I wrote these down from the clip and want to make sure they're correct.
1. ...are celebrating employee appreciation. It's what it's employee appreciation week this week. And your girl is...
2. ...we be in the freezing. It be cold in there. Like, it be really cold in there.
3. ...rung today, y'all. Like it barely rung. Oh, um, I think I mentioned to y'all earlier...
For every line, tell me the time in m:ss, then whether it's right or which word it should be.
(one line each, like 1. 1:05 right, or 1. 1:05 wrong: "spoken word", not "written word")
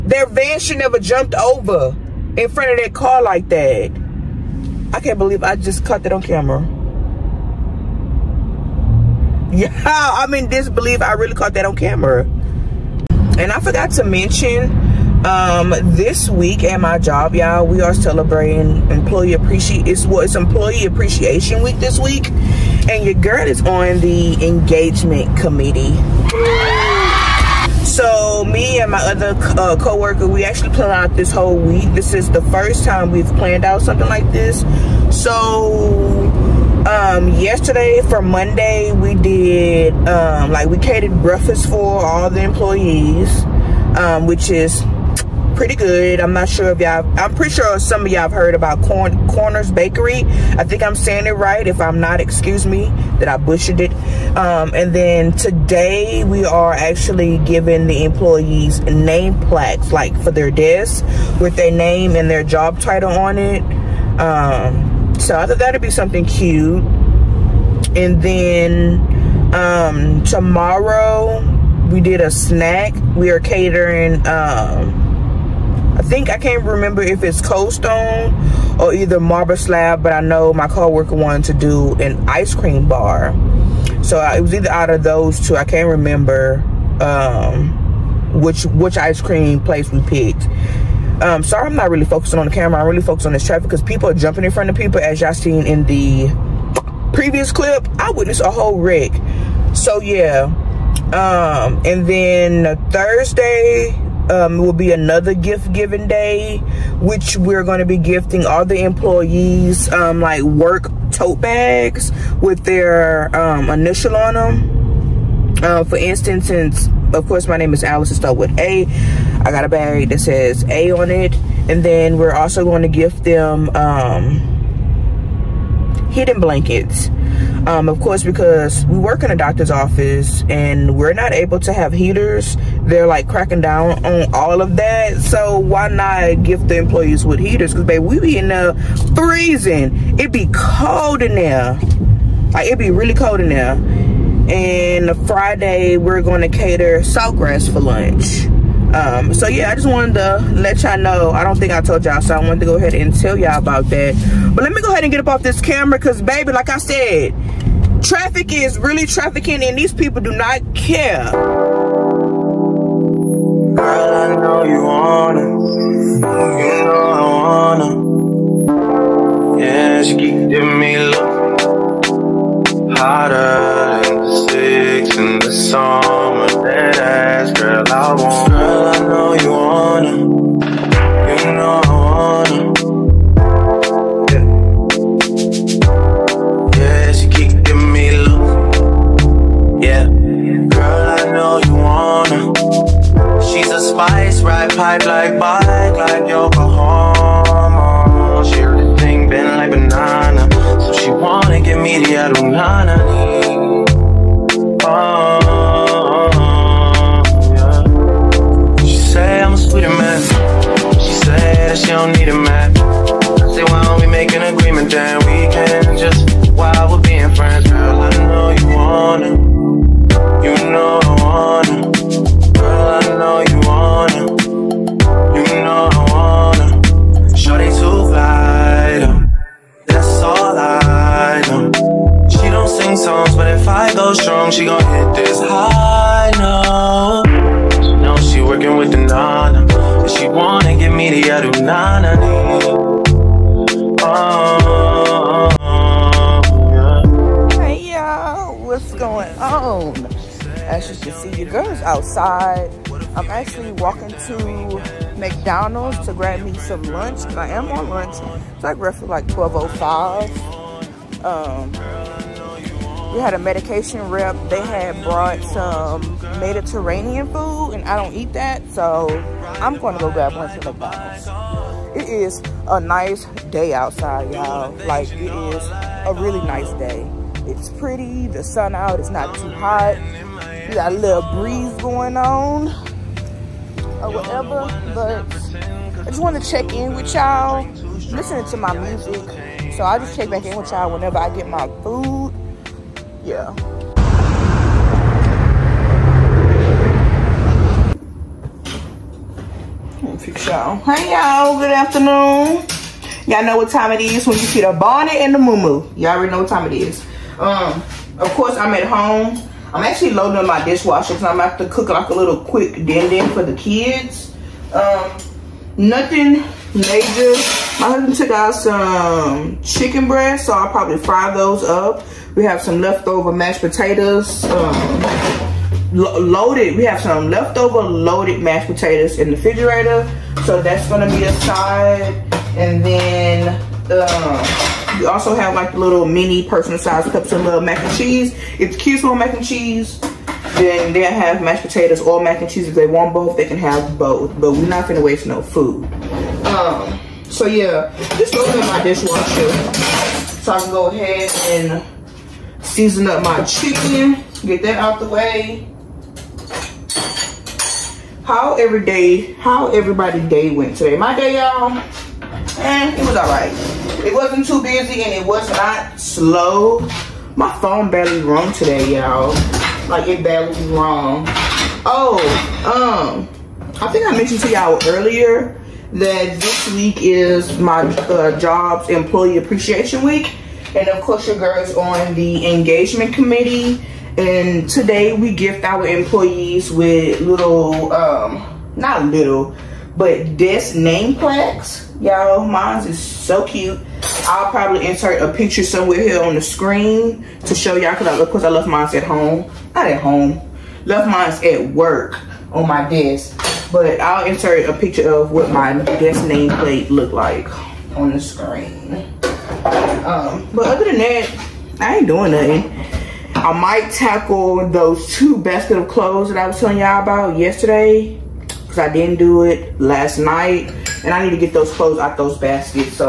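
1. 0:17 right
2. 2:18 right
3. 6:08 right.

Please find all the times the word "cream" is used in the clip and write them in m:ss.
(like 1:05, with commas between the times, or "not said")
1:22, 1:29.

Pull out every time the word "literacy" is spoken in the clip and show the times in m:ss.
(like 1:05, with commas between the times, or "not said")
not said.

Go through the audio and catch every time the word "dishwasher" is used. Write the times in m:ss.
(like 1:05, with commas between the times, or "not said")
5:10, 5:48.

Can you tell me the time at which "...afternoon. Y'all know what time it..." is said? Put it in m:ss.
5:01.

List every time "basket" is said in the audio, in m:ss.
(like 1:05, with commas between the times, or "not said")
6:55, 7:02.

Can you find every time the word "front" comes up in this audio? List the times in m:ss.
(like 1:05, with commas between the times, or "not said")
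0:02, 1:34.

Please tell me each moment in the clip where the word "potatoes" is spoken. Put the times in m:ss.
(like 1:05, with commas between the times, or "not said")
5:23, 5:28, 5:41.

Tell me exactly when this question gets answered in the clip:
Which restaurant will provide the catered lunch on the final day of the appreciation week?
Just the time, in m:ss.
2:27.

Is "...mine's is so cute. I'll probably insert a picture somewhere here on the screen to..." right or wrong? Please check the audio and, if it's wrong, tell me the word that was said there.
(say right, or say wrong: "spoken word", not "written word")
right.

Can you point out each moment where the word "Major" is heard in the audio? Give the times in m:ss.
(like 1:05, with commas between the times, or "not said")
5:16.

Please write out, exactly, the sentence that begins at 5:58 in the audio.
How every day, how everybody day went today.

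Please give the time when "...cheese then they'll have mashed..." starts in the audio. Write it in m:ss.
5:39.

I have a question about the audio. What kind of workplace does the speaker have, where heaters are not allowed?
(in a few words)
doctor's office.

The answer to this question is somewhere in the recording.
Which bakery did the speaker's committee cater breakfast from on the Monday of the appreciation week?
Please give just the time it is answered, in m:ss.
0:48.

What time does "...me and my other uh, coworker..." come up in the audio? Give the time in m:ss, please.
0:28.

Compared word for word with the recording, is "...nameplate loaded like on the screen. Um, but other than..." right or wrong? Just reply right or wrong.
wrong.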